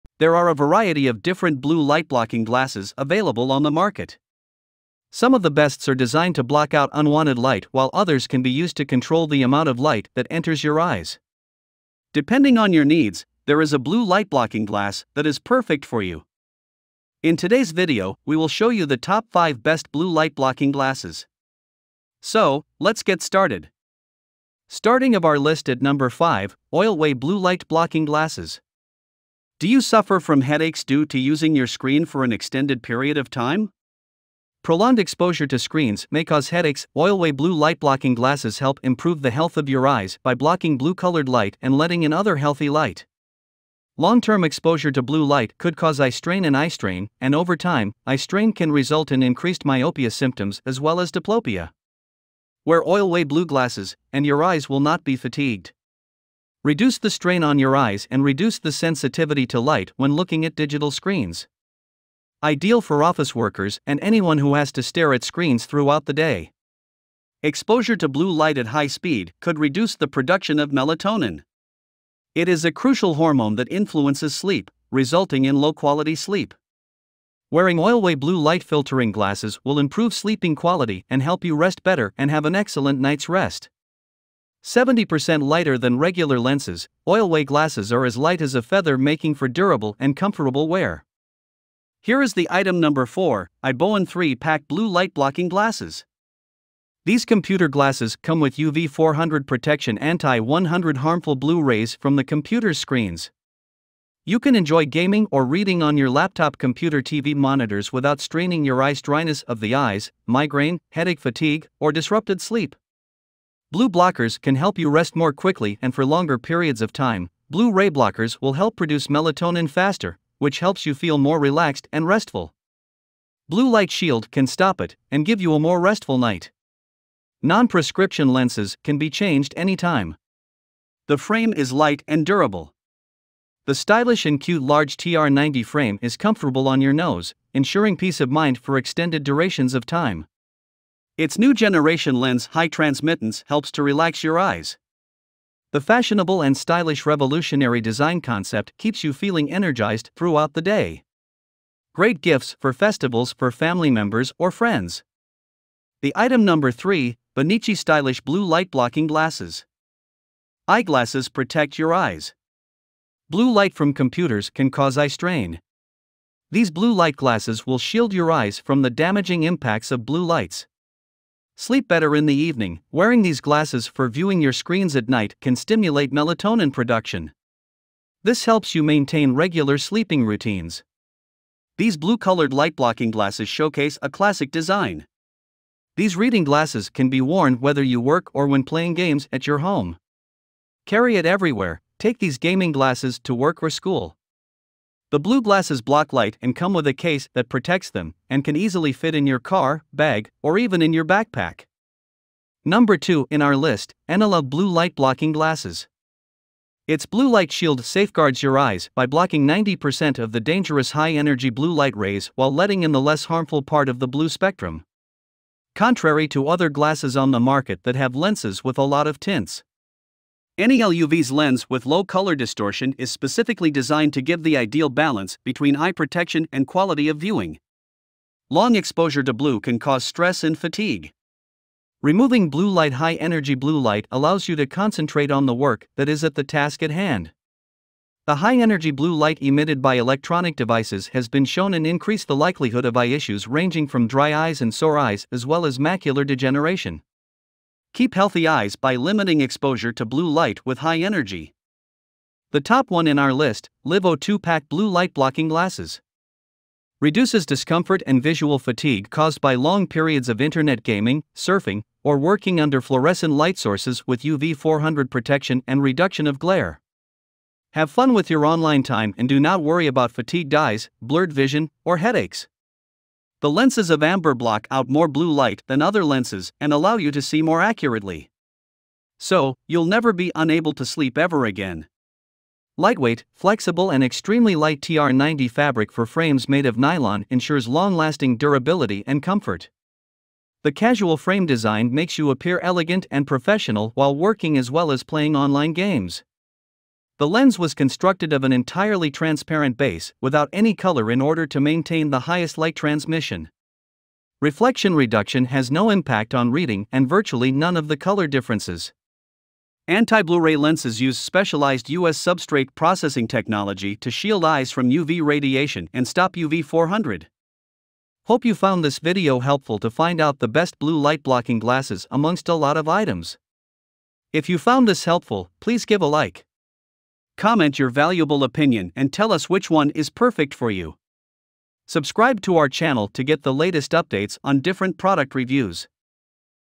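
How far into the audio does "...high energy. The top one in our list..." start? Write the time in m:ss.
4:10.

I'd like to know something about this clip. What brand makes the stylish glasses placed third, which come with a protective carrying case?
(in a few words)
BENICCI.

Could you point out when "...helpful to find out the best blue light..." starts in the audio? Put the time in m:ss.
5:19.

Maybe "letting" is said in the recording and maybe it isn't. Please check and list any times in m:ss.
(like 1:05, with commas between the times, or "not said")
0:41, 3:32.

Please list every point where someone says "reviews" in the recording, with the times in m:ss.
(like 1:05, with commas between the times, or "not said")
5:35.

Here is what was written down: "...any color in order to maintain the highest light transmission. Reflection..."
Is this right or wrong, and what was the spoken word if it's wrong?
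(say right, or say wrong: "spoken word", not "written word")
right.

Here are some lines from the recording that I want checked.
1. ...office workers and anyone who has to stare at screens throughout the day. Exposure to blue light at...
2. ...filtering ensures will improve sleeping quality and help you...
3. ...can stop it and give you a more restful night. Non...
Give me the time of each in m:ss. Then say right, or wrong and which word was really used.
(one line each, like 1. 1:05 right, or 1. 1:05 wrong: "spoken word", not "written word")
1. 1:03 right
2. 1:18 wrong: "glasses", not "ensures"
3. 2:04 right.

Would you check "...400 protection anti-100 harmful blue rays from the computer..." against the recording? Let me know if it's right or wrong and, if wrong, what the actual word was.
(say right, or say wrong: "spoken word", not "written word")
right.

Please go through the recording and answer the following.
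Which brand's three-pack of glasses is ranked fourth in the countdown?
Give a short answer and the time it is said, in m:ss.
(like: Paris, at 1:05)
IBOANN, at 1:33.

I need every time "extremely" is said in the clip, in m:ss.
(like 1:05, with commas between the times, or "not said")
4:44.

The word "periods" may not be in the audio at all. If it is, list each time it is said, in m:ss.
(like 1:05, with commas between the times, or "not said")
0:32, 1:56, 4:19.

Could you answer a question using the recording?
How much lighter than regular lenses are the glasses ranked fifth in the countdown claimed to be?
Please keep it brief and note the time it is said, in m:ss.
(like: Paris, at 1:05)
70%, at 1:24.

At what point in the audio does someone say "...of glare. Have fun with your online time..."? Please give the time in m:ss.
4:26.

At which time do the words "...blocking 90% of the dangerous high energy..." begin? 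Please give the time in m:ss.
3:29.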